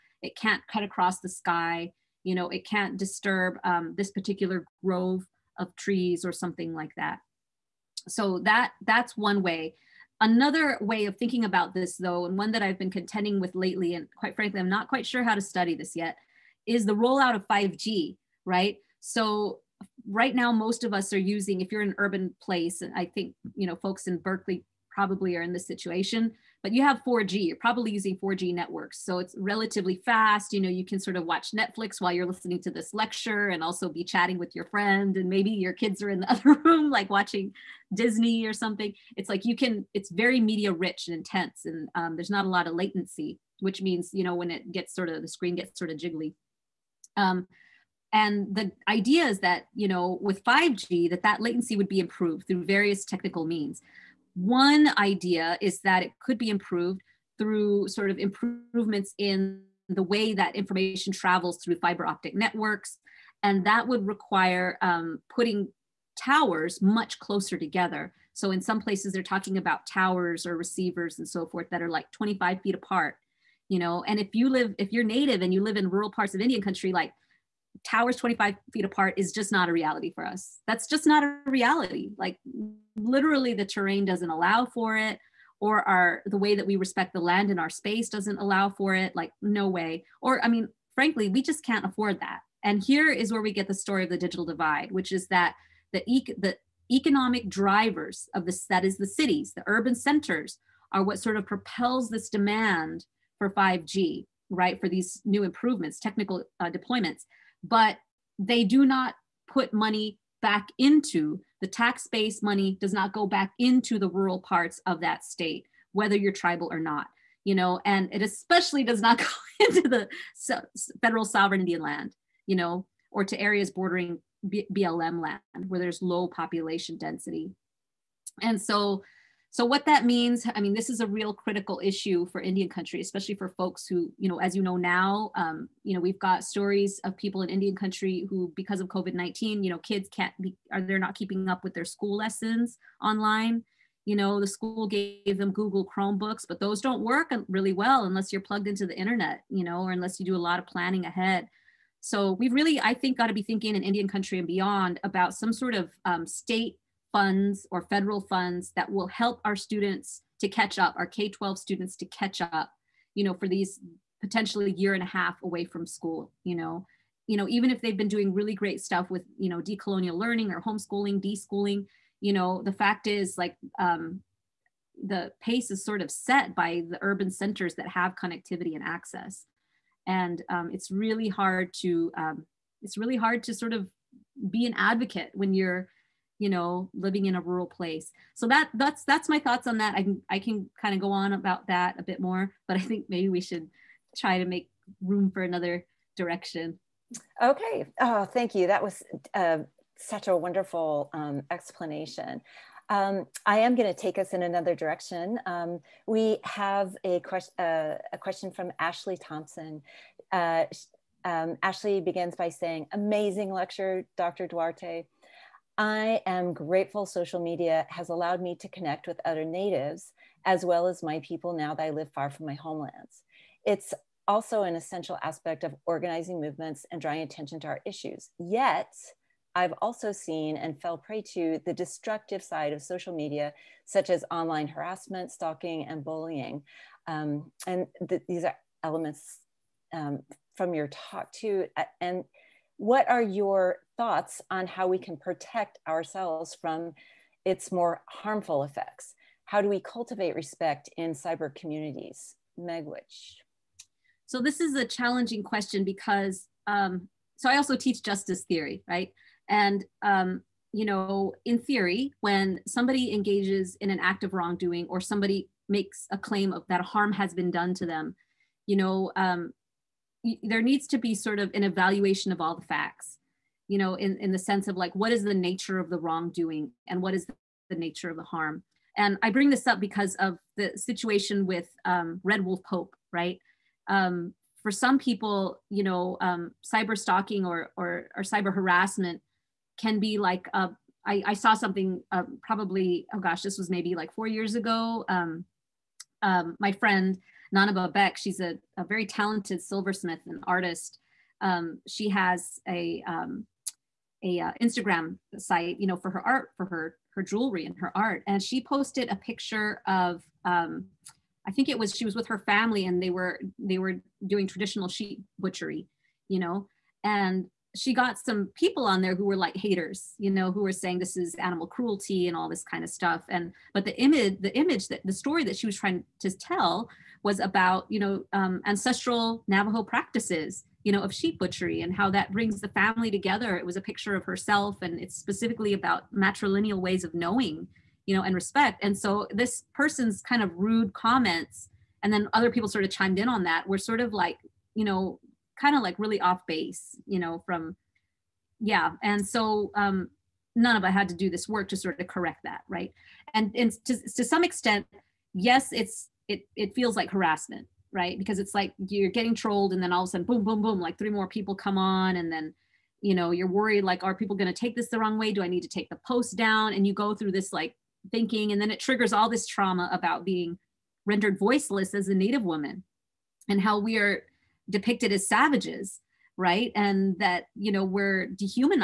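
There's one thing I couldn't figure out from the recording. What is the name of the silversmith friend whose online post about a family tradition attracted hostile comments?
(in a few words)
Nana Babek.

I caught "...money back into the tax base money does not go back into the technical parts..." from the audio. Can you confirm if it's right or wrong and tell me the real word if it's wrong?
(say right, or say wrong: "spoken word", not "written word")
wrong: "rural", not "technical".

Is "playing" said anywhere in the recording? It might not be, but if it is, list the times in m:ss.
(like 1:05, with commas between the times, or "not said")
not said.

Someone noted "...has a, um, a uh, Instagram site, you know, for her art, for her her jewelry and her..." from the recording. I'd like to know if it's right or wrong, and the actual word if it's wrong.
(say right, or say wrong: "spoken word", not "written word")
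right.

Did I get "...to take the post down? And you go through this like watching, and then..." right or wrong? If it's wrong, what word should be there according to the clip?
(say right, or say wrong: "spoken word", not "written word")
wrong: "thinking", not "watching".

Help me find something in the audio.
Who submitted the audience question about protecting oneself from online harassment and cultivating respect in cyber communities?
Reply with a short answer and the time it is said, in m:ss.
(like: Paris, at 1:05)
Ashley Thompson, at 3:28.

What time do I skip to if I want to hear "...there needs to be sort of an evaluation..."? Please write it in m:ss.
4:30.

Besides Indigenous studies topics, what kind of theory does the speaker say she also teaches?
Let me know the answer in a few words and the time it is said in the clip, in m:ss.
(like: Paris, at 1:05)
justice theory, at 4:18.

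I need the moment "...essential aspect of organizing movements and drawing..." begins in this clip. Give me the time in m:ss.
3:44.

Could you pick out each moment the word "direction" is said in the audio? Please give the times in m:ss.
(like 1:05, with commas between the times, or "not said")
3:16, 3:24.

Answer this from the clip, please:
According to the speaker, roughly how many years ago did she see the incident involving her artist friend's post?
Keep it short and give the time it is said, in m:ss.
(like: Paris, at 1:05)
4, at 4:54.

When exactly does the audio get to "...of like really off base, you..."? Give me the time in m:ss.
5:45.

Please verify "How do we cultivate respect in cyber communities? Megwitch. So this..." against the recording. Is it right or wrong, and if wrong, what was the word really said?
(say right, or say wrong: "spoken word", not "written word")
right.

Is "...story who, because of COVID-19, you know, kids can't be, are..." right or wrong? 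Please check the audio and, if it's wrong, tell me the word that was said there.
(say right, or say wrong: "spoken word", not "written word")
wrong: "country", not "story".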